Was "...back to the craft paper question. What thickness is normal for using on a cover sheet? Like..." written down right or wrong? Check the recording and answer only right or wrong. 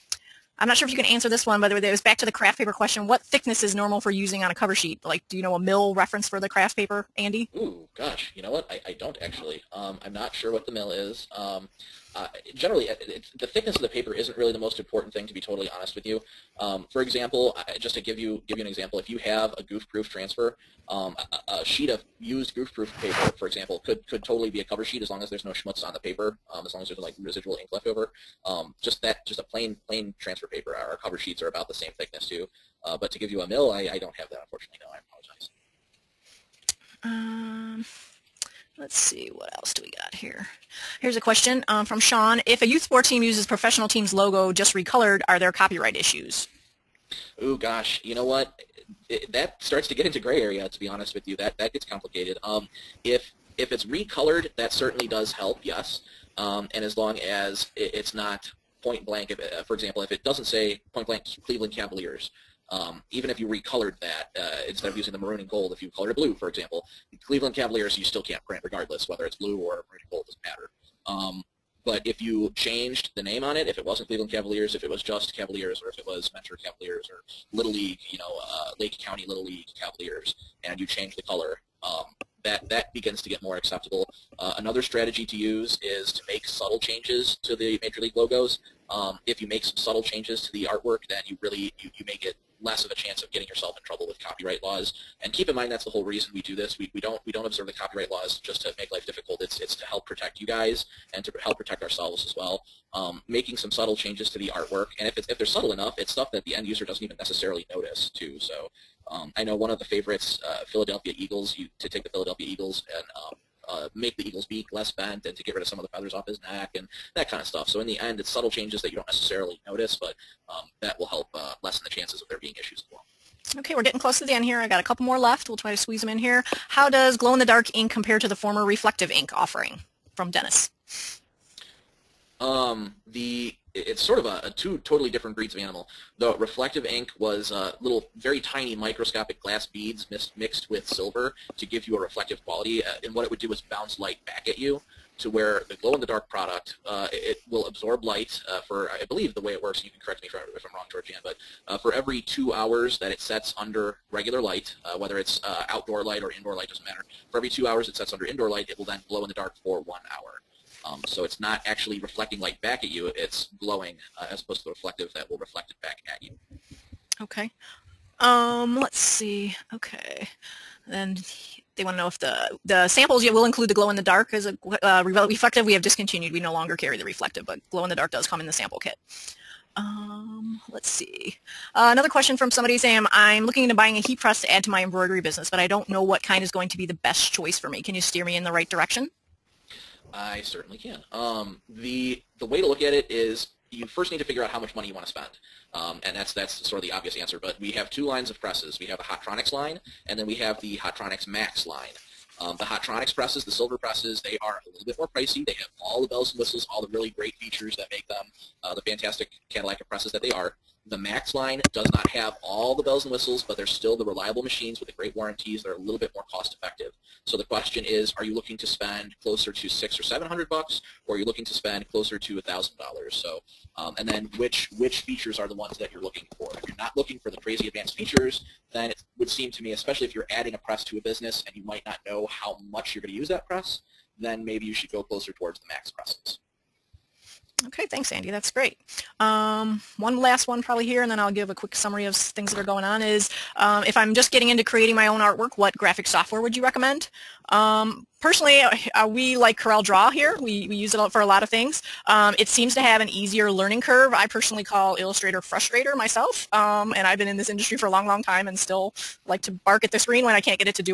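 right.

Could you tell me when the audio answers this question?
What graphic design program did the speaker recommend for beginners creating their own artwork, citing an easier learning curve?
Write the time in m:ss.
4:09.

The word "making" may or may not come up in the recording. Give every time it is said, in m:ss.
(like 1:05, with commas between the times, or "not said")
1:43.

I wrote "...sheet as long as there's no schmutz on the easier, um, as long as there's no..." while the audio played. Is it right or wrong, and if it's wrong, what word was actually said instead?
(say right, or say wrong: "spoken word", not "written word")
wrong: "paper", not "easier".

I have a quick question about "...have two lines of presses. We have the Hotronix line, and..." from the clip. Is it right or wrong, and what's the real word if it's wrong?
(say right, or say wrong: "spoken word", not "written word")
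right.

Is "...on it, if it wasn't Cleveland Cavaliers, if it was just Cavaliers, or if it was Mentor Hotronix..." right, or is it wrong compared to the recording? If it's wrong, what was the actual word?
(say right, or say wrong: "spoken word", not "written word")
wrong: "Cavaliers", not "Hotronix".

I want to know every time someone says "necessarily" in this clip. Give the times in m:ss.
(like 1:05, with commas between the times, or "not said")
1:47, 1:59.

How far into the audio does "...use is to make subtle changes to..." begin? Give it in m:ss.
1:25.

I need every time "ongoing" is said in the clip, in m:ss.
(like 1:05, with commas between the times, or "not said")
not said.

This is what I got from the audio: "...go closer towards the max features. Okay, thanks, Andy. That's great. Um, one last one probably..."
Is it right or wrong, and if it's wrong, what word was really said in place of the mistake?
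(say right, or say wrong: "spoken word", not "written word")
wrong: "presses", not "features".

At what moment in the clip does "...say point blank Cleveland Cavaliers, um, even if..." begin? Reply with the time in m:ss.
1:00.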